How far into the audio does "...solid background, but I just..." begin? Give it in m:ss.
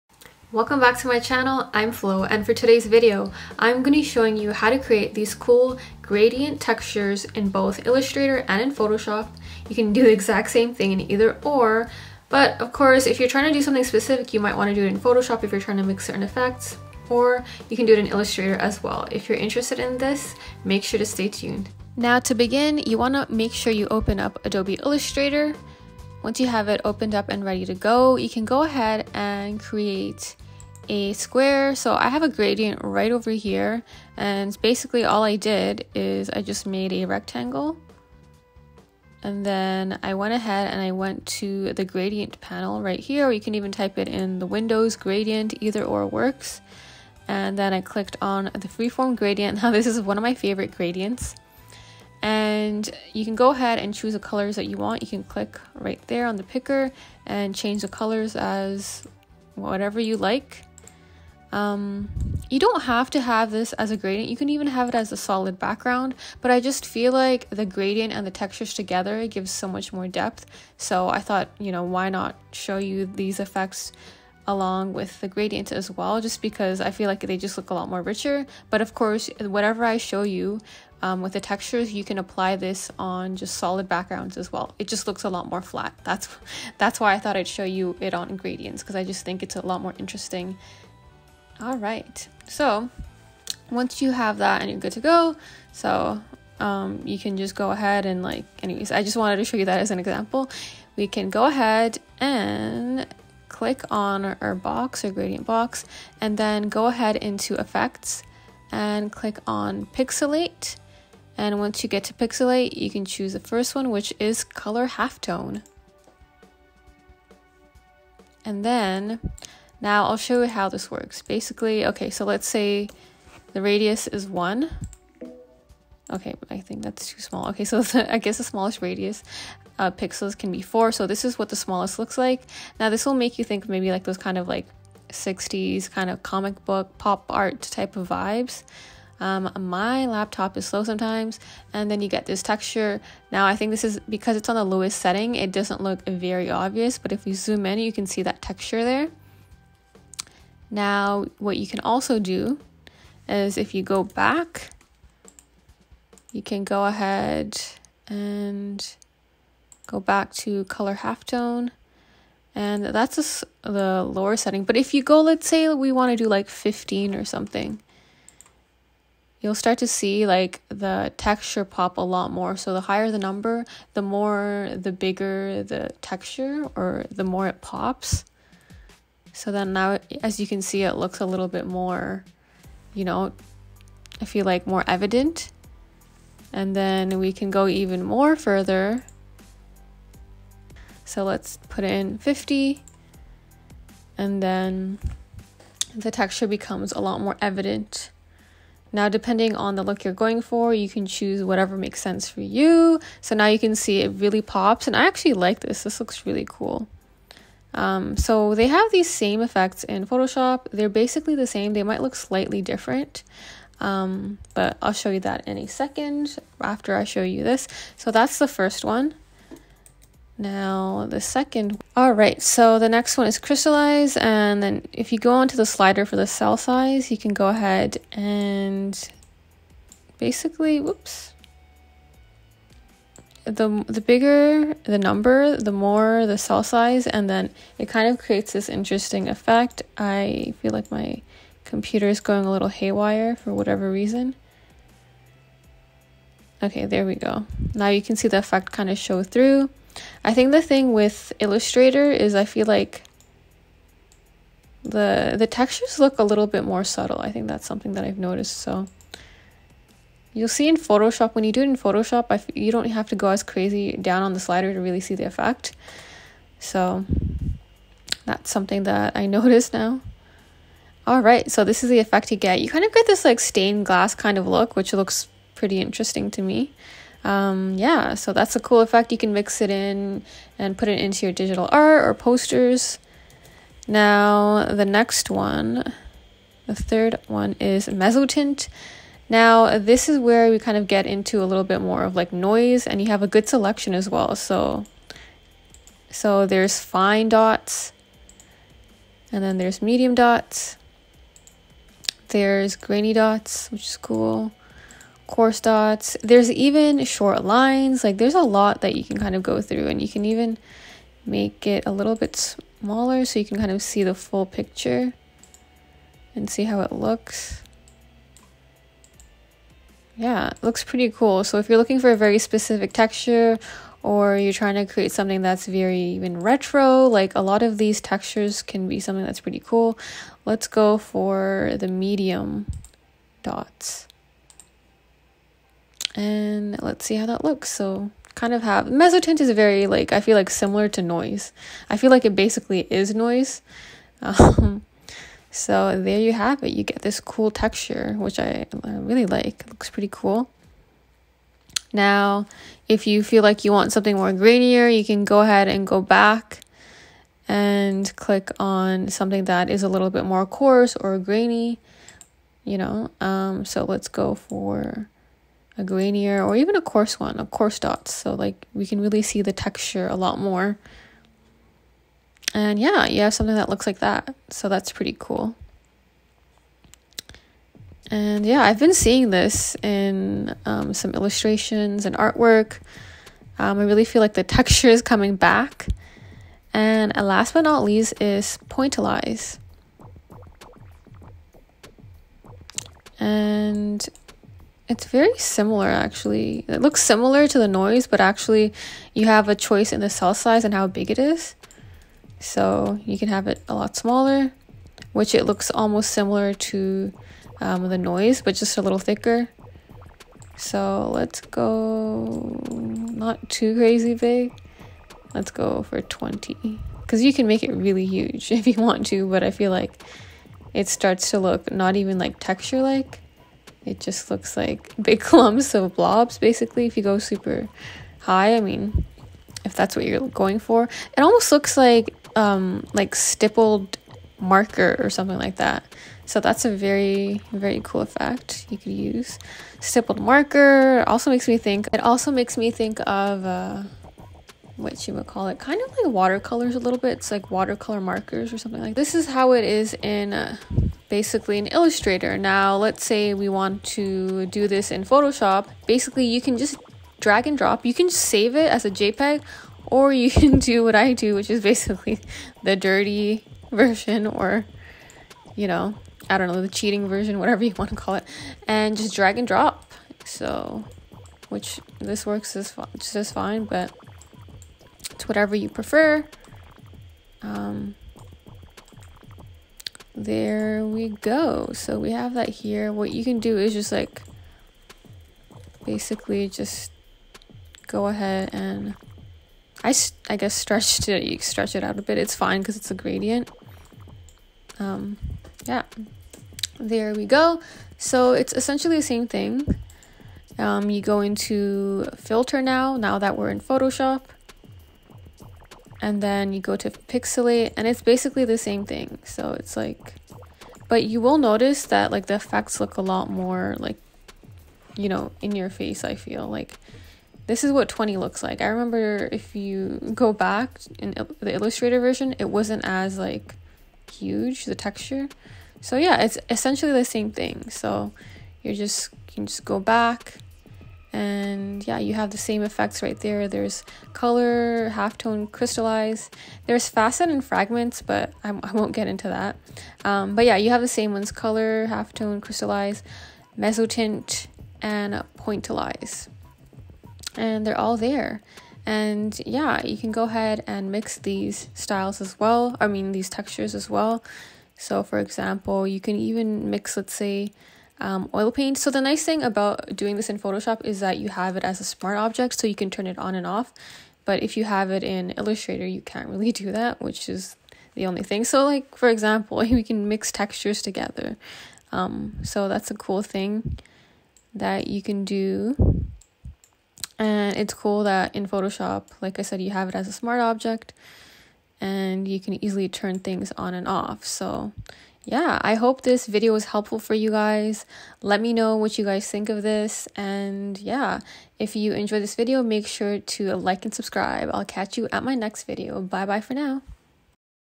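1:05.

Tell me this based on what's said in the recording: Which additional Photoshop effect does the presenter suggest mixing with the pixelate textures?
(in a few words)
oil paint.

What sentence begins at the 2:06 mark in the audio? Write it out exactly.
Okay, I think that's too small.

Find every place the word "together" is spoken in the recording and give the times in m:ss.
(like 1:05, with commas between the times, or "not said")
1:08, 9:30.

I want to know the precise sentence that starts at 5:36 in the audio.
And let's see how that looks.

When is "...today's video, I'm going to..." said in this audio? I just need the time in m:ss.
0:02.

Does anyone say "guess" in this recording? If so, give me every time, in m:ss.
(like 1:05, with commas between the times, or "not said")
2:08, 8:10.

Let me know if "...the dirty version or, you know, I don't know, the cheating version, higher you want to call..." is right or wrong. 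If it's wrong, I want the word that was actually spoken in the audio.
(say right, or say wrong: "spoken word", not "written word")
wrong: "whatever", not "higher".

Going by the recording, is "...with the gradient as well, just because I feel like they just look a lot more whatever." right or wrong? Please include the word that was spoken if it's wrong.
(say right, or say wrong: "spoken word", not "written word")
wrong: "richer", not "whatever".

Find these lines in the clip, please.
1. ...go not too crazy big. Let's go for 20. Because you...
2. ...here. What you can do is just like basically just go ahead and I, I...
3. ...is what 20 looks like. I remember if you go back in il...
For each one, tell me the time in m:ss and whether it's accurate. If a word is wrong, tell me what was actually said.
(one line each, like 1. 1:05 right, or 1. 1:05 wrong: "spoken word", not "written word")
1. 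6:51 right
2. 8:02 right
3. 8:37 right.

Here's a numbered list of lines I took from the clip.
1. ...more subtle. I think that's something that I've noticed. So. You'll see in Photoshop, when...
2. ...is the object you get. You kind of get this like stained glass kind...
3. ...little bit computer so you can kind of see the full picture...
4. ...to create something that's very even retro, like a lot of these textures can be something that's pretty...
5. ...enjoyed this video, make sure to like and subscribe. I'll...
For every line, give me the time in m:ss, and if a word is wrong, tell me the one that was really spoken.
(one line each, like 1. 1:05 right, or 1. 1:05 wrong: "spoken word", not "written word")
1. 4:16 right
2. 4:31 wrong: "effect", not "object"
3. 5:11 wrong: "smaller", not "computer"
4. 5:24 right
5. 9:51 right.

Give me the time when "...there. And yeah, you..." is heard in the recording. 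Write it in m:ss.
9:07.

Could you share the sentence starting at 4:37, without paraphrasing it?
Um, yeah, so that's a cool effect.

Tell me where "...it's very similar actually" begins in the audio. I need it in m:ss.
6:34.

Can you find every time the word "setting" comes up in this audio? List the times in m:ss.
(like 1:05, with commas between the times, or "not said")
2:24, 2:44.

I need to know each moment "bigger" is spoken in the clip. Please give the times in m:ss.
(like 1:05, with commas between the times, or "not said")
2:54, 3:54.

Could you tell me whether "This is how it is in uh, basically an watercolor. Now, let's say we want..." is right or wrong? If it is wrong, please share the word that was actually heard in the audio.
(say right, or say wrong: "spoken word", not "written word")
wrong: "illustrator", not "watercolor".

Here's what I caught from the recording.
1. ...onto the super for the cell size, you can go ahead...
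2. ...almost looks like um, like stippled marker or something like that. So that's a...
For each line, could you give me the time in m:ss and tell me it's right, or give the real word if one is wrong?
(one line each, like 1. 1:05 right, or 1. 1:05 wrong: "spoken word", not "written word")
1. 3:45 wrong: "slider", not "super"
2. 7:11 right.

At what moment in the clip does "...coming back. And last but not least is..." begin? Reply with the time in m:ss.
6:25.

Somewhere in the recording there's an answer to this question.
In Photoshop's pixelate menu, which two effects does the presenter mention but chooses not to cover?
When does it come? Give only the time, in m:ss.
8:56.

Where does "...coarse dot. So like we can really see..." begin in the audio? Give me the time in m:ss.
6:07.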